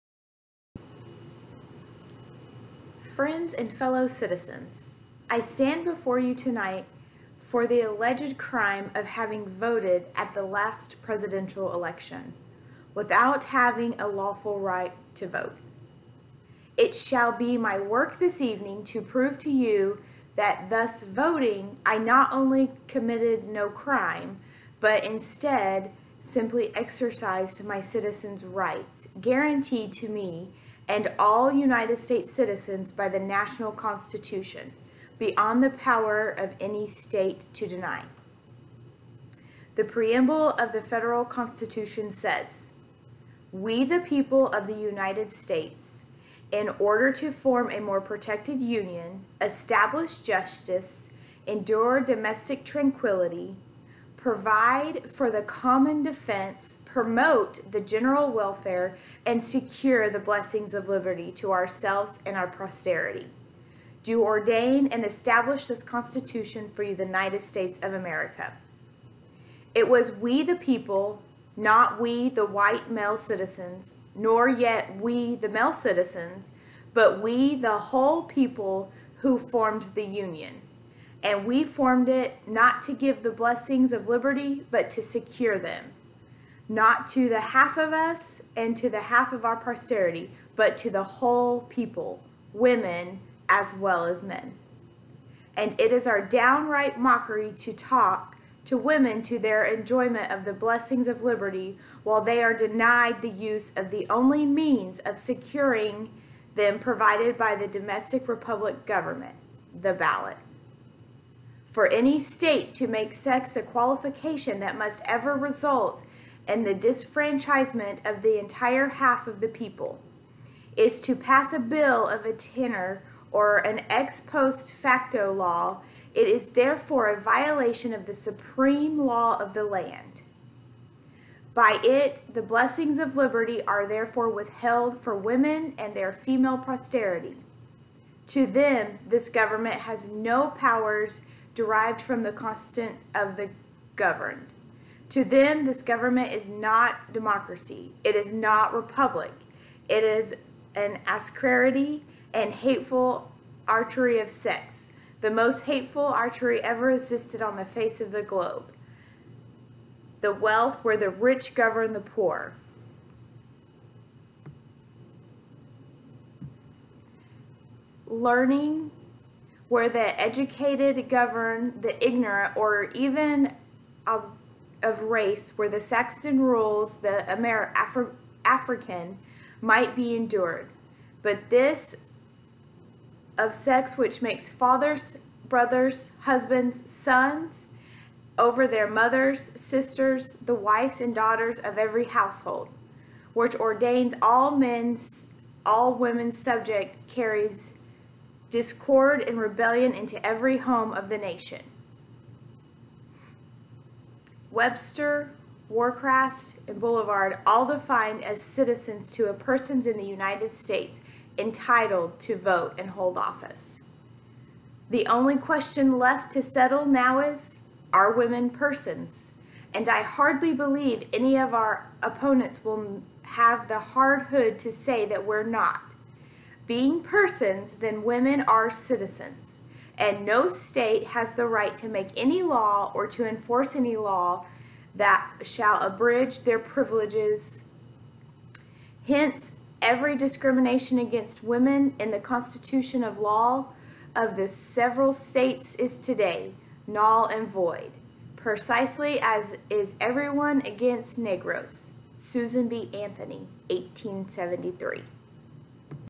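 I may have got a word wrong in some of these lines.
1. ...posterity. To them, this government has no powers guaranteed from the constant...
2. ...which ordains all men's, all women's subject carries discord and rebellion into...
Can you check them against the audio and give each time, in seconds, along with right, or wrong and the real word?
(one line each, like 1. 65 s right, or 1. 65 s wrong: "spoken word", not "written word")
1. 136 s wrong: "derived", not "guaranteed"
2. 193 s right.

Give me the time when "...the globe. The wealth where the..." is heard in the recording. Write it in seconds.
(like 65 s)
158 s.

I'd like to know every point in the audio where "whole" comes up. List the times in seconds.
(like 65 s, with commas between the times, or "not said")
77 s, 91 s.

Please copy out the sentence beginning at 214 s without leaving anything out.
The only question left to settle now is, are women persons?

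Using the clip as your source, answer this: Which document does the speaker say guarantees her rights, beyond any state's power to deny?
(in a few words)
national constitution.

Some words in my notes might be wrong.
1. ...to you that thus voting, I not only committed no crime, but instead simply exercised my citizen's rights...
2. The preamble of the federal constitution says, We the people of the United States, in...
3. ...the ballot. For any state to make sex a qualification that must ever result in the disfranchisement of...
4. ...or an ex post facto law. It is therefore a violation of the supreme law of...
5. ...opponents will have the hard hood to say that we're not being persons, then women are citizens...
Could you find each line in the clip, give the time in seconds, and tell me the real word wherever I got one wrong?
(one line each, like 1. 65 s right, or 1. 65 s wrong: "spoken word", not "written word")
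1. 19 s right
2. 39 s right
3. 109 s right
4. 123 s right
5. 222 s right.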